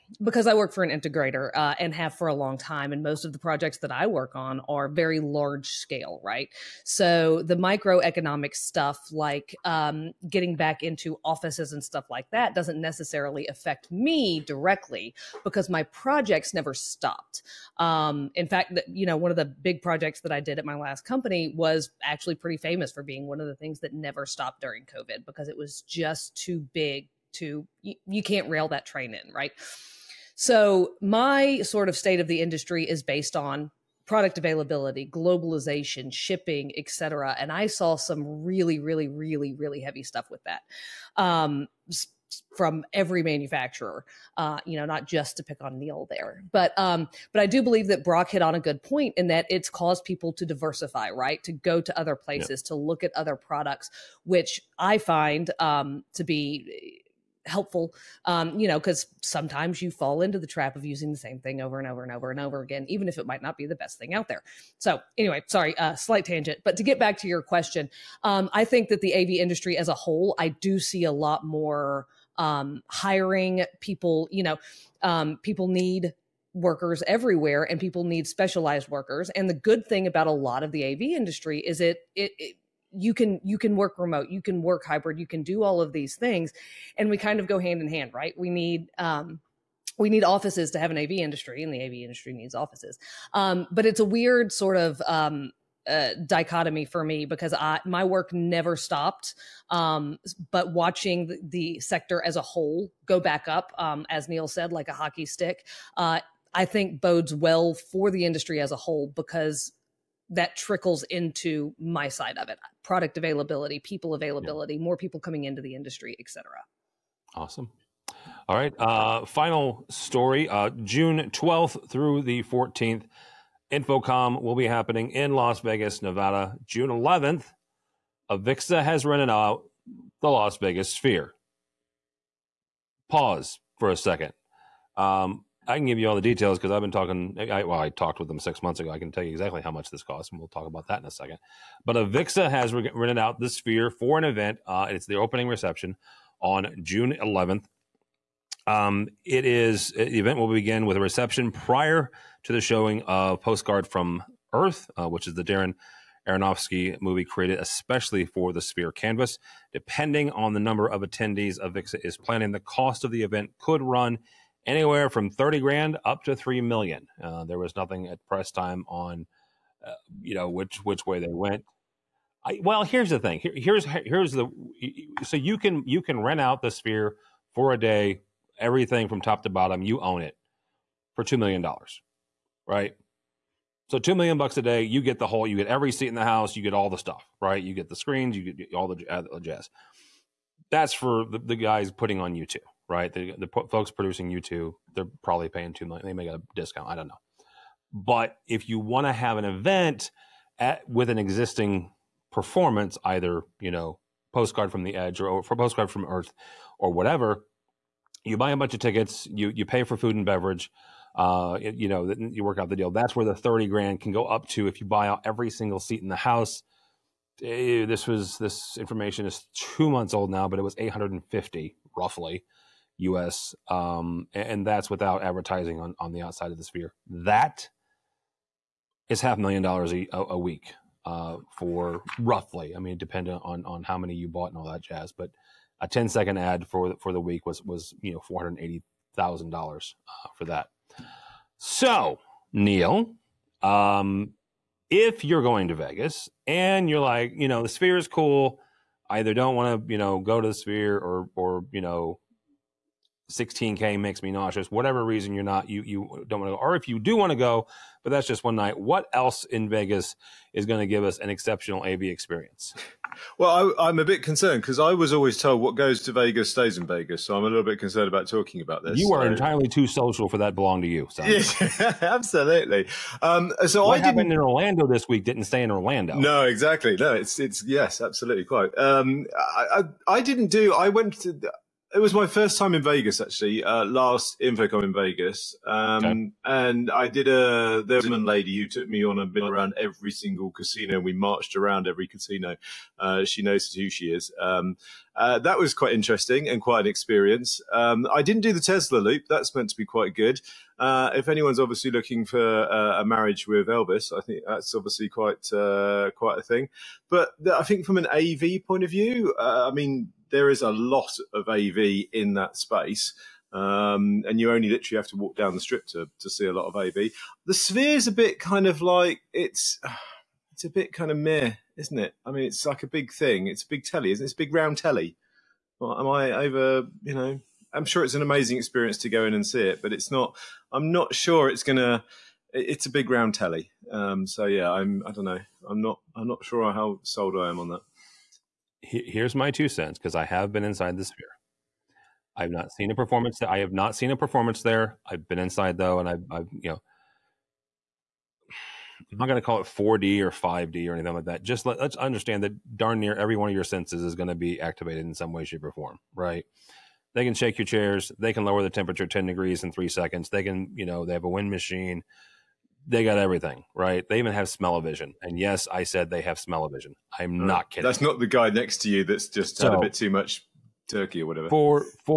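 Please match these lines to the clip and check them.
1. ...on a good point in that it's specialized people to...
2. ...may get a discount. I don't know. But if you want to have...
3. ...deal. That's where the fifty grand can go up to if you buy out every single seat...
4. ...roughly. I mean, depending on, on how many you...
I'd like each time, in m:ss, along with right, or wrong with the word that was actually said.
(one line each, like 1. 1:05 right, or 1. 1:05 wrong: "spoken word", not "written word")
1. 0:48 wrong: "caused", not "specialized"
2. 3:16 right
3. 3:32 wrong: "thirty", not "fifty"
4. 3:52 right.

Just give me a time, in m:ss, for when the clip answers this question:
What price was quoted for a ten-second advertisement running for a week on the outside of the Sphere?
3:58.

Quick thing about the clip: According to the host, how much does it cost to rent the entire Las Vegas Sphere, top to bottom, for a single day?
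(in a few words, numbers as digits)
$2 million.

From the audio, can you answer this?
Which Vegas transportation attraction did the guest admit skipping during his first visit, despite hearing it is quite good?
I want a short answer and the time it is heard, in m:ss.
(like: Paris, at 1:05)
Tesla loop, at 4:58.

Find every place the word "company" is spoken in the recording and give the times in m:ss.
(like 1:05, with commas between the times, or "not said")
0:21.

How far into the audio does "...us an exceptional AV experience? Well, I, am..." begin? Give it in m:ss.
4:21.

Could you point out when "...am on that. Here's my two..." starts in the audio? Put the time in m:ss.
5:37.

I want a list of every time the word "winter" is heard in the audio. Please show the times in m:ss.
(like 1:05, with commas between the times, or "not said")
not said.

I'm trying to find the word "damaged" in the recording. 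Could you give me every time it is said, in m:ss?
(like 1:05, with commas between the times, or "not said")
not said.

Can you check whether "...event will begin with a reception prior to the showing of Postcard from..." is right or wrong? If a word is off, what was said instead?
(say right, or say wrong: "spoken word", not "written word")
right.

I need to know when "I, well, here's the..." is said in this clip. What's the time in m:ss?
2:52.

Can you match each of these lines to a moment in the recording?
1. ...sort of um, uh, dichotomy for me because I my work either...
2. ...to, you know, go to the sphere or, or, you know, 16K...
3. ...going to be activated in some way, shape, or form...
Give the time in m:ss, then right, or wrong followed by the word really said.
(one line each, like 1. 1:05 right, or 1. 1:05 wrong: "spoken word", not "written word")
1. 1:34 wrong: "never", not "either"
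2. 4:09 right
3. 5:54 right.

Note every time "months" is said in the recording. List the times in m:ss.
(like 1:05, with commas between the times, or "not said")
2:18, 3:39.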